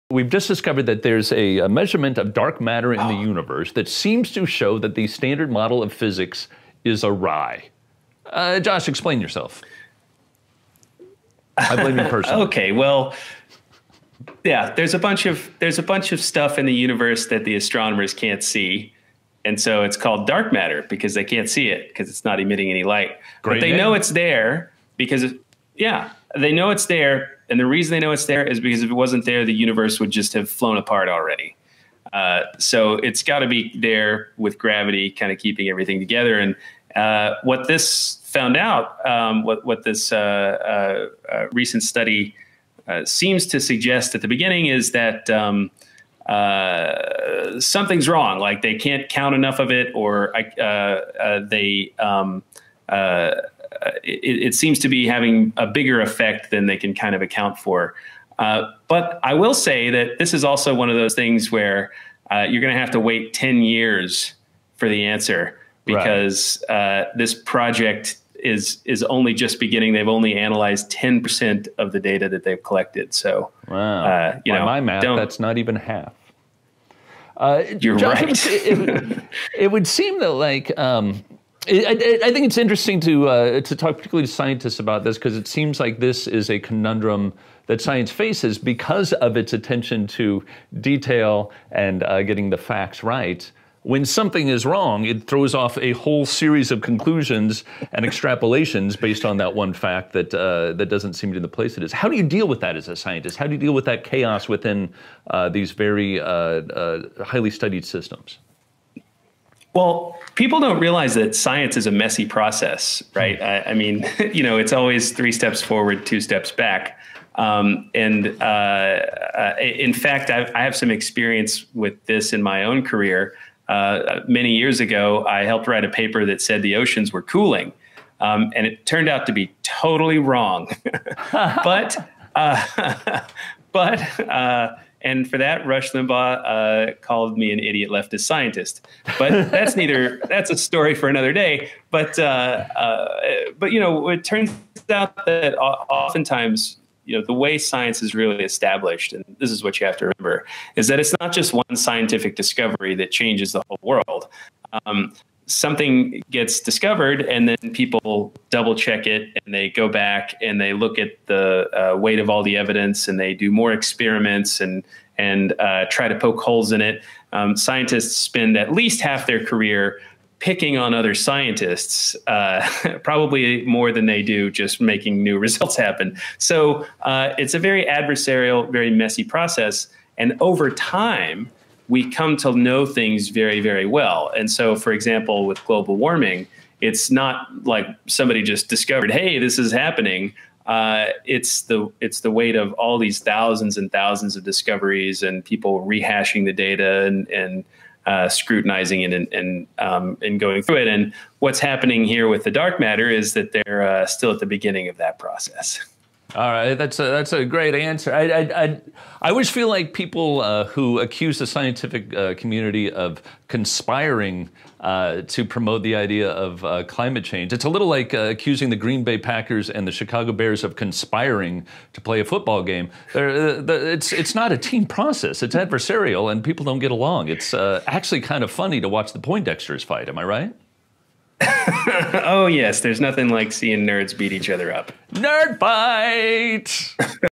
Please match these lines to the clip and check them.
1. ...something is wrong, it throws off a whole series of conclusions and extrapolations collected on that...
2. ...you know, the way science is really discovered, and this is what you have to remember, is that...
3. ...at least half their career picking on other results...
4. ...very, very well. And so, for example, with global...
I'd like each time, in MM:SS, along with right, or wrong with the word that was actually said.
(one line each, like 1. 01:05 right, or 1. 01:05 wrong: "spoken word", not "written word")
1. 01:34 wrong: "based", not "collected"
2. 02:27 wrong: "established", not "discovered"
3. 02:48 wrong: "scientists", not "results"
4. 03:03 right.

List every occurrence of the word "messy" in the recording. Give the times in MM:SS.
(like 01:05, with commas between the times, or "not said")
01:51, 02:58.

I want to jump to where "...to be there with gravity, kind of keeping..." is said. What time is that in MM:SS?
00:33.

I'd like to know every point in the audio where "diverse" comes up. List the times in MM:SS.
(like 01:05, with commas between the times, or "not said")
not said.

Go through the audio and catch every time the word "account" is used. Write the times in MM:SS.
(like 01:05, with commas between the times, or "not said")
00:57.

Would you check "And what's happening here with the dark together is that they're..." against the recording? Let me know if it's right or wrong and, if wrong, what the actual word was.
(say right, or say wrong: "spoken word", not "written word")
wrong: "matter", not "together".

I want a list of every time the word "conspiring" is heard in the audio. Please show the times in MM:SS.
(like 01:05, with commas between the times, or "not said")
03:33, 03:40.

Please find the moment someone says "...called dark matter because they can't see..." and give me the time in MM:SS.
00:19.